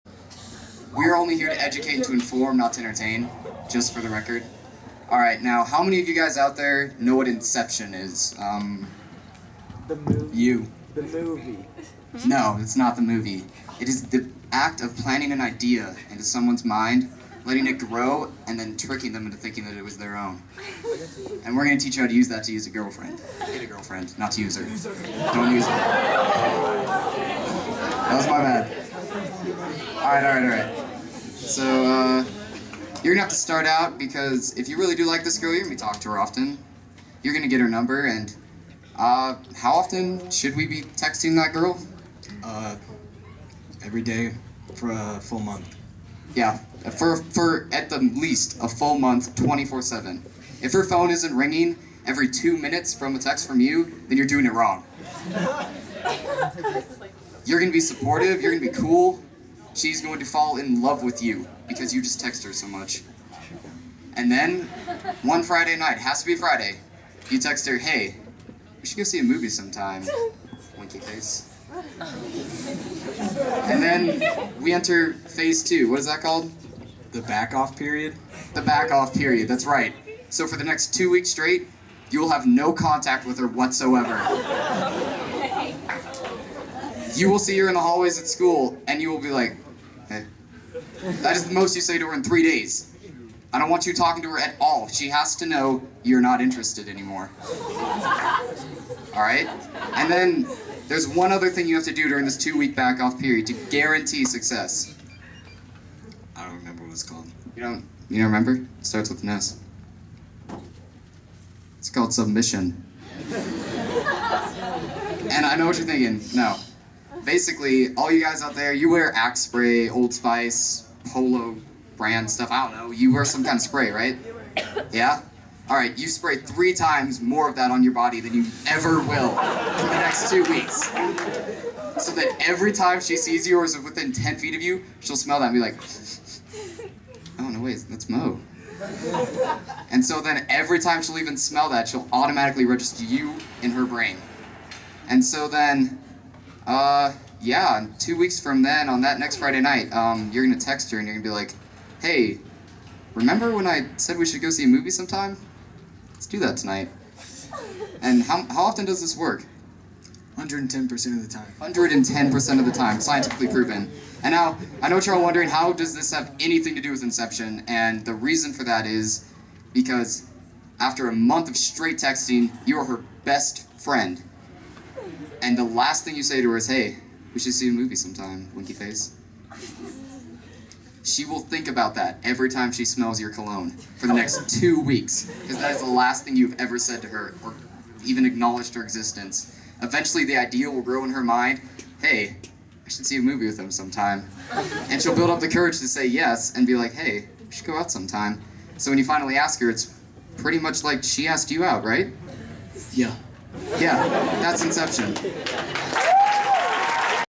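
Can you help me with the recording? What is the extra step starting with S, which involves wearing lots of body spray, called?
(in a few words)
Submission.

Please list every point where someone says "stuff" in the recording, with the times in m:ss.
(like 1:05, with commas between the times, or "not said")
2:02.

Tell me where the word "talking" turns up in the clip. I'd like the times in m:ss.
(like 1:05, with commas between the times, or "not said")
0:35, 1:33.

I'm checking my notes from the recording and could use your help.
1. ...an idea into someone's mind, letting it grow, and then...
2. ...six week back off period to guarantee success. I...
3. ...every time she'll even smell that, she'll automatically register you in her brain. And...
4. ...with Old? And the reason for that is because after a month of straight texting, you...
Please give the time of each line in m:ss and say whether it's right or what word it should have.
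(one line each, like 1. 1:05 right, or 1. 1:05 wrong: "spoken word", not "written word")
1. 0:15 right
2. 1:42 wrong: "two", not "six"
3. 2:20 right
4. 2:46 wrong: "Inception", not "Old".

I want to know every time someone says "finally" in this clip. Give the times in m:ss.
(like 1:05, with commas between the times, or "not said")
3:19.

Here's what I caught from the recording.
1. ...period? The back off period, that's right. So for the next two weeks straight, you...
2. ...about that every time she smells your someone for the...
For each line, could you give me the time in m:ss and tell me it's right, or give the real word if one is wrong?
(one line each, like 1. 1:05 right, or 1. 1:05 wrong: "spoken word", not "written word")
1. 1:17 right
2. 3:01 wrong: "cologne", not "someone".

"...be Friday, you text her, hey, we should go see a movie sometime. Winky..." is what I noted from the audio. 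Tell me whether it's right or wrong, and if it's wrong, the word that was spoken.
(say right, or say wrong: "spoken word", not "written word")
right.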